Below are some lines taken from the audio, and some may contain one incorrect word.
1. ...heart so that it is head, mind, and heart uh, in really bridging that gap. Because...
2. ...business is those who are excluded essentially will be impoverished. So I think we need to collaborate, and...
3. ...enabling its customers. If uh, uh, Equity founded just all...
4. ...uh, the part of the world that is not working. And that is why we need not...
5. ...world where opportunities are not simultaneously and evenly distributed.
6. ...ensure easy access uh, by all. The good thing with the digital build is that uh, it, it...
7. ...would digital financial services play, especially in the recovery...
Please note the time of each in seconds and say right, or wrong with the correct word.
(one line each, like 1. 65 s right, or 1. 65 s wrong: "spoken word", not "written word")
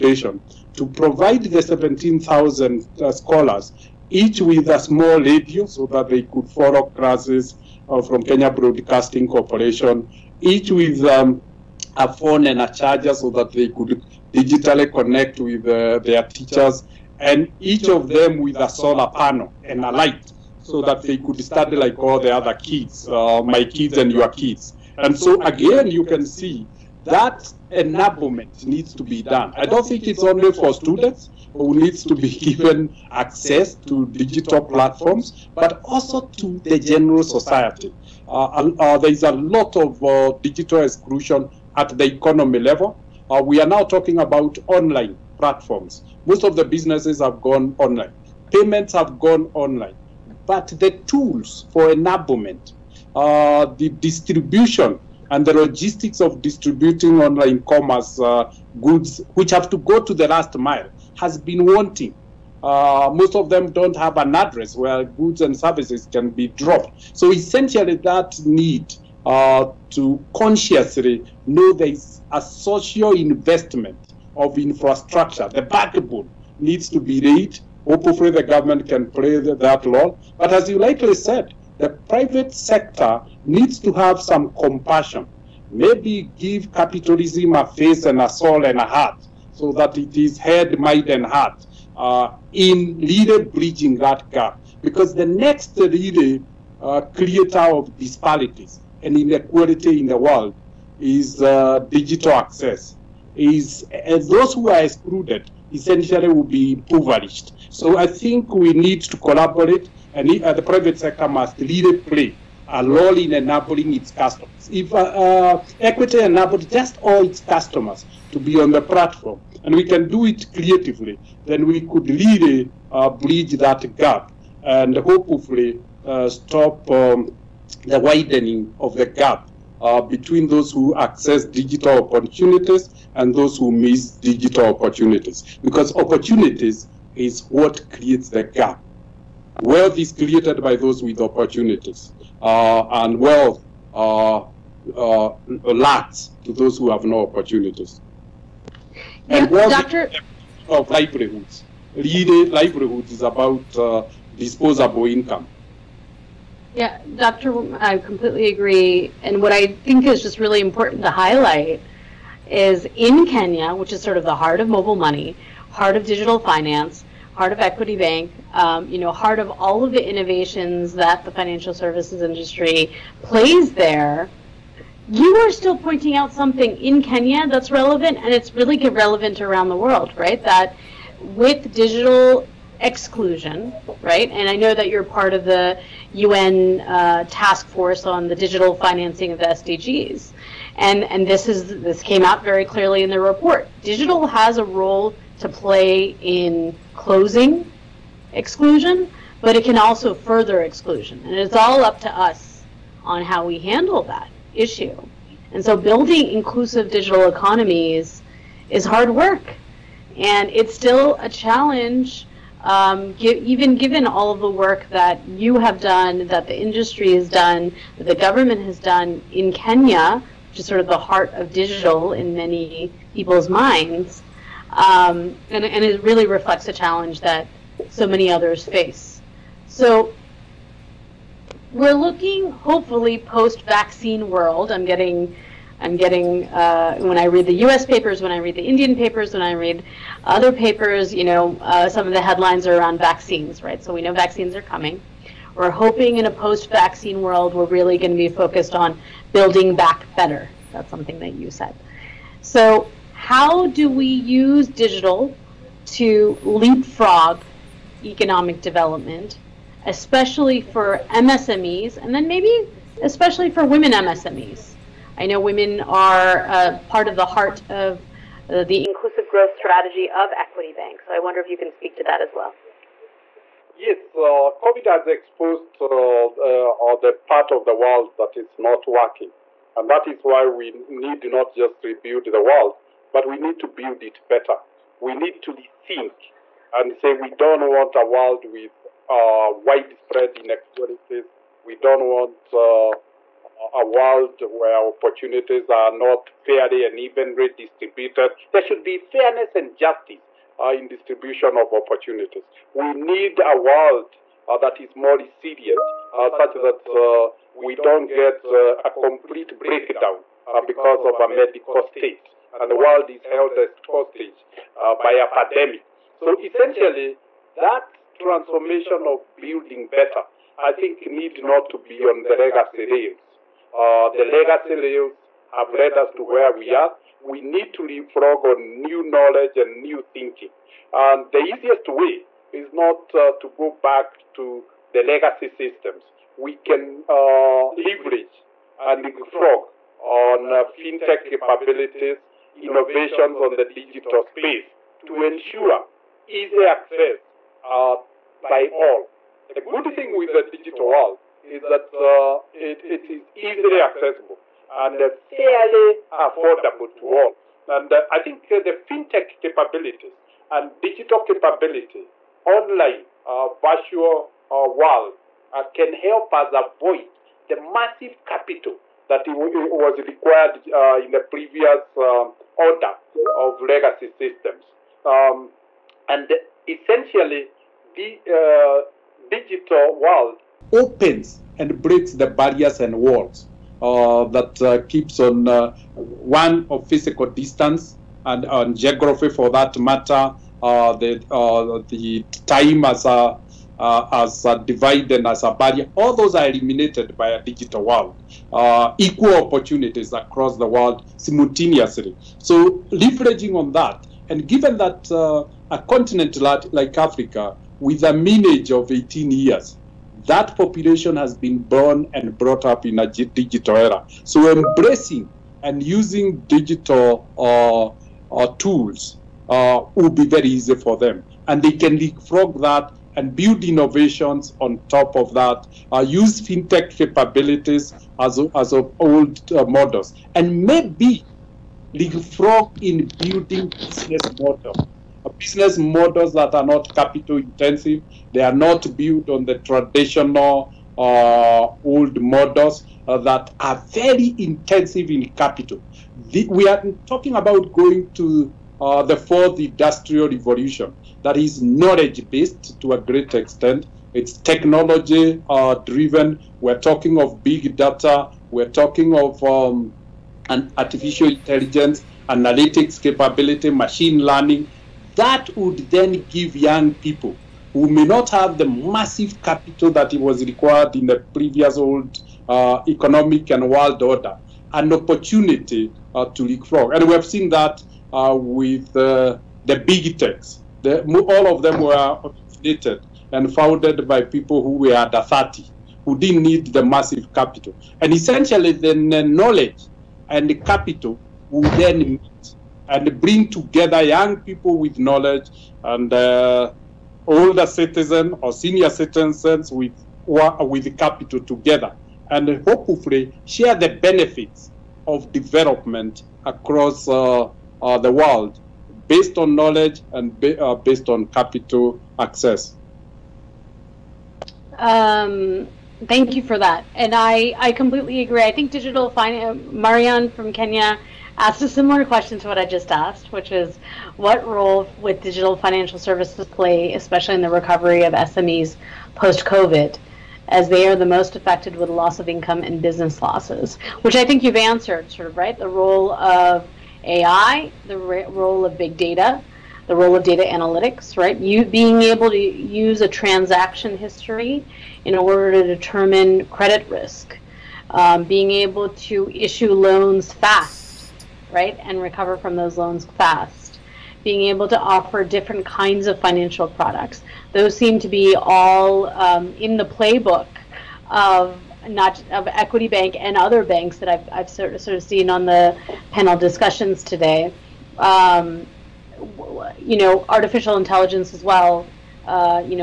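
1. 88 s right
2. 102 s wrong: "access", not "business"
3. 113 s wrong: "enabled", not "founded"
4. 276 s right
5. 293 s wrong: "fairly", not "simultaneously"
6. 345 s wrong: "world", not "build"
7. 524 s right.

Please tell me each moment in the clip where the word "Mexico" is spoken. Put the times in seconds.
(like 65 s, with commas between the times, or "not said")
not said.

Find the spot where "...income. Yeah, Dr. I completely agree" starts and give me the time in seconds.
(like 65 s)
155 s.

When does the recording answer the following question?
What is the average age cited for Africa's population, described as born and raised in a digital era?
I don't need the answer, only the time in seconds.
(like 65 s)
408 s.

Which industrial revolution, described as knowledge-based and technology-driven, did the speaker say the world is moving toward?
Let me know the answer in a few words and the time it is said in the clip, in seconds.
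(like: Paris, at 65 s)
The fourth, at 449 s.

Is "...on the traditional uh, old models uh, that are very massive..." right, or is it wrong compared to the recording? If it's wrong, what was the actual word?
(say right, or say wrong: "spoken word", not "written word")
wrong: "intensive", not "massive".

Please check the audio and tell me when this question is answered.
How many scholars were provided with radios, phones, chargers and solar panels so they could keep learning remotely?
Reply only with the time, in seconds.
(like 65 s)
1 s.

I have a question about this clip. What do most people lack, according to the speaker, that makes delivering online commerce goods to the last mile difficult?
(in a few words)
An address.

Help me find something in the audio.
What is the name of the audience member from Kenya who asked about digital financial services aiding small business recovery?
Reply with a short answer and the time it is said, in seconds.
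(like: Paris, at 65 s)
Marianne, at 519 s.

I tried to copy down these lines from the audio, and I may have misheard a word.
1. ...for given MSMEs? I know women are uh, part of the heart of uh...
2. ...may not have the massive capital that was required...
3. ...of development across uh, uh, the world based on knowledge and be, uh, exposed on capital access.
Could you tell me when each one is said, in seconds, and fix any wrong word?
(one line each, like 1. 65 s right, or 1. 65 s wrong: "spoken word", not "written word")
1. 263 s wrong: "women", not "given"
2. 467 s right
3. 505 s wrong: "based", not "exposed".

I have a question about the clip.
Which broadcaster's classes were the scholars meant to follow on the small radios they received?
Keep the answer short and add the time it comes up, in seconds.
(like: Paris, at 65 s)
Kenya Broadcasting Corporation, at 8 s.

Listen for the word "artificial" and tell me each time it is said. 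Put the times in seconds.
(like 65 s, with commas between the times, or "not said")
460 s, 570 s.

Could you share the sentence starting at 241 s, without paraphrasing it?
You know, uh, some of the headlines are around vaccines, right?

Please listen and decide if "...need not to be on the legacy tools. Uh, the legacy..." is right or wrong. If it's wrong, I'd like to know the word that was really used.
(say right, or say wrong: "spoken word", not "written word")
wrong: "rails", not "tools".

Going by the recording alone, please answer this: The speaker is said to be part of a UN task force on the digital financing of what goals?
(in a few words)
The SDGs.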